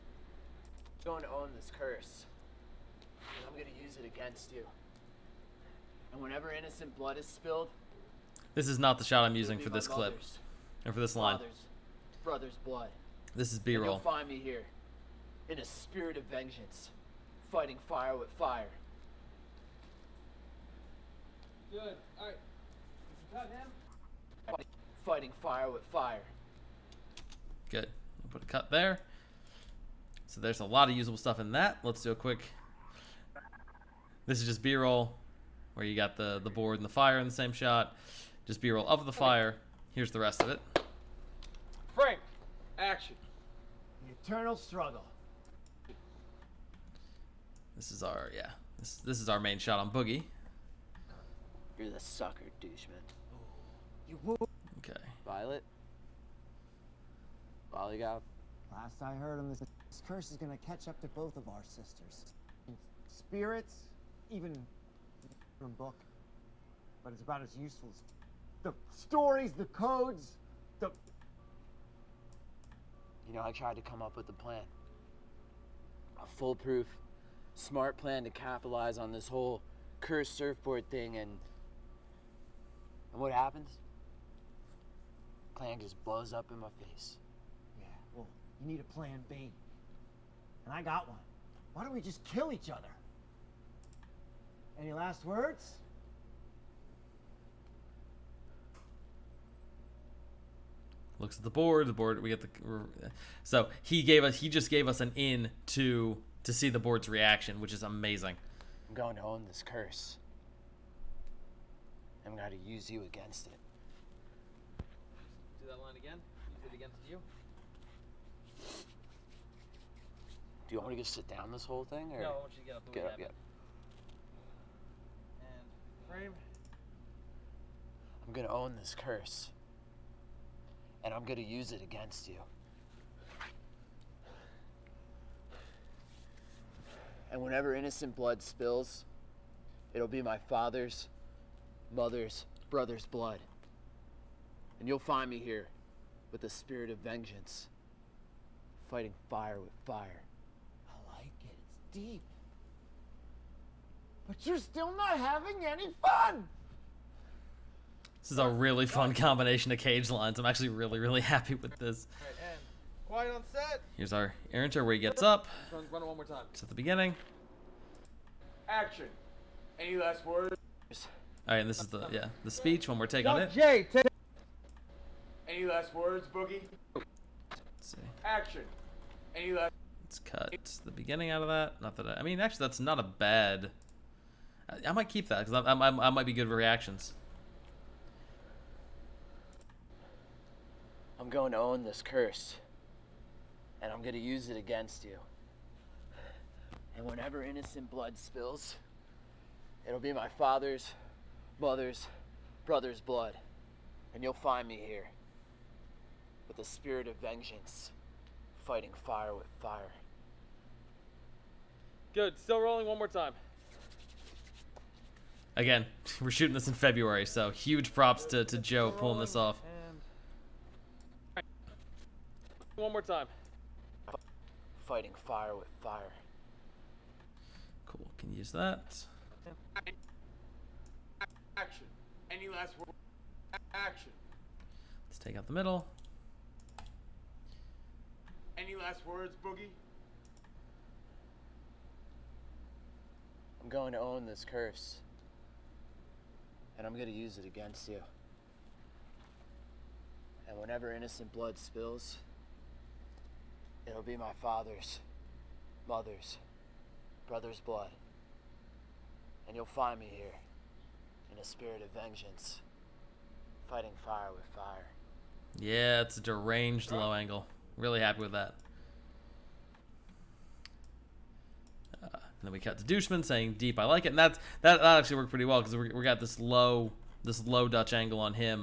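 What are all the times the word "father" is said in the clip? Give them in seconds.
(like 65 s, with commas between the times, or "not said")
140 s, 200 s, 254 s.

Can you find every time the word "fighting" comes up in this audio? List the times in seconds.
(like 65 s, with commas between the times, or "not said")
17 s, 25 s, 148 s, 208 s, 224 s, 263 s.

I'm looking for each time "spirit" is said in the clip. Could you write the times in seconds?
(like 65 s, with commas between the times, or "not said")
15 s, 63 s, 146 s, 206 s, 261 s.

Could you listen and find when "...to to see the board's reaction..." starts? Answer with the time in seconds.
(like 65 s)
105 s.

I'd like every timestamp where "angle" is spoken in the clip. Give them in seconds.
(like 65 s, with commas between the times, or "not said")
267 s, 277 s.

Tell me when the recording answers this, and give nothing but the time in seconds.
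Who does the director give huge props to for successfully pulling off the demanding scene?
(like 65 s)
218 s.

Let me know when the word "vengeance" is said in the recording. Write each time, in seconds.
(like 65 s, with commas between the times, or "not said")
16 s, 146 s, 207 s, 262 s.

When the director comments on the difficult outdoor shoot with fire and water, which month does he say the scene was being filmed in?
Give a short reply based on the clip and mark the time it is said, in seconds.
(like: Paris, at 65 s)
February, at 216 s.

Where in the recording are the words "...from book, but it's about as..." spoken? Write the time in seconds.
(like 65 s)
65 s.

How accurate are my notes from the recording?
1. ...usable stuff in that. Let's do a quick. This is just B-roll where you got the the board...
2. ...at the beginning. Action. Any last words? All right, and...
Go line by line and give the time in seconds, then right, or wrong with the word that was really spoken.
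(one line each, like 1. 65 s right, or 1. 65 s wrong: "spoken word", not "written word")
1. 30 s right
2. 166 s right.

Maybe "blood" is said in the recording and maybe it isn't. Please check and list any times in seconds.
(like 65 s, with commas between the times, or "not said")
6 s, 12 s, 138 s, 143 s, 197 s, 202 s, 251 s, 257 s.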